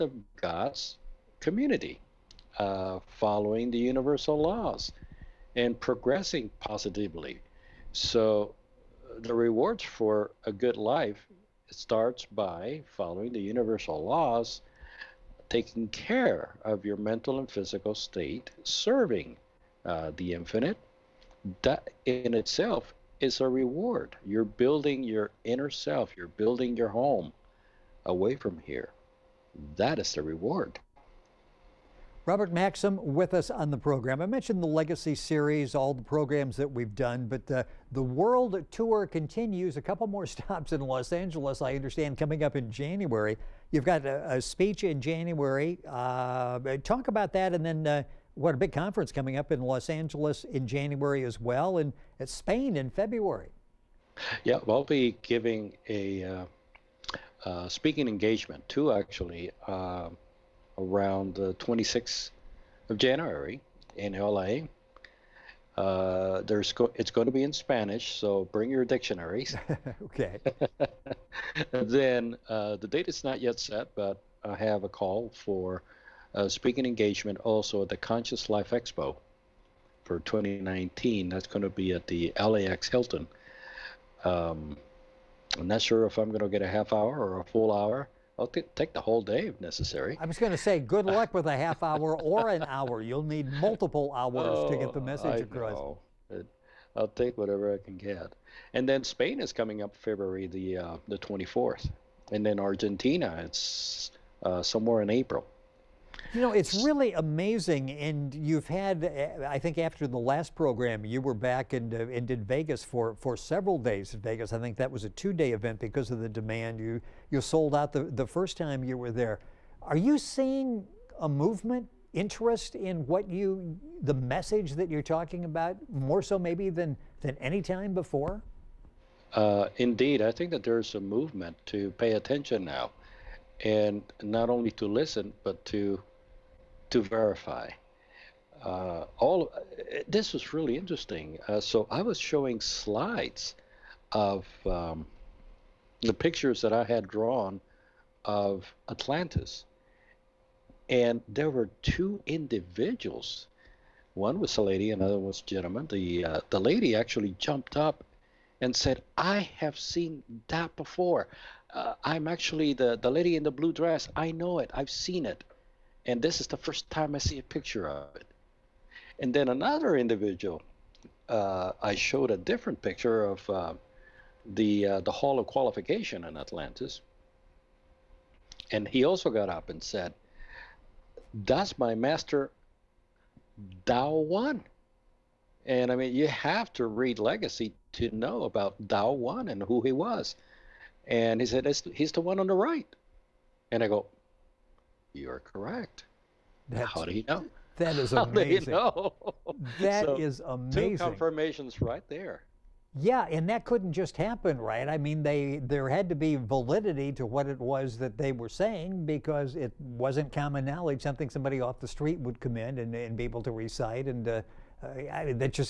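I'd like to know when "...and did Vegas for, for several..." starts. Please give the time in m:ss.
1:52.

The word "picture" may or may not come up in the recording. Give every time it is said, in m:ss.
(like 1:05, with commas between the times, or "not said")
2:26, 2:47, 2:52.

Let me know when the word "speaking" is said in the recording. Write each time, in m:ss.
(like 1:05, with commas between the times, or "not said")
0:57, 1:16.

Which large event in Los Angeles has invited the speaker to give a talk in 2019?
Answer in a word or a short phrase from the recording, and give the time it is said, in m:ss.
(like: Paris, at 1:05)
Conscious Life Expo, at 1:17.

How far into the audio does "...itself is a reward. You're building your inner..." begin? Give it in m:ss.
0:22.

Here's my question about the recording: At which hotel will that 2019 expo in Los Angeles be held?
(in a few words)
LAX Hilton.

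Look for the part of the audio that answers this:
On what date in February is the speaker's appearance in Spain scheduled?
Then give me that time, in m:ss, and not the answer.
1:39.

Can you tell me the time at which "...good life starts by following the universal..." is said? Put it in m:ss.
0:10.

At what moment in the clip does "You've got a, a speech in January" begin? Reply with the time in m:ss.
0:43.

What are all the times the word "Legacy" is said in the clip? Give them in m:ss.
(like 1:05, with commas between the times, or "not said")
0:34, 3:07.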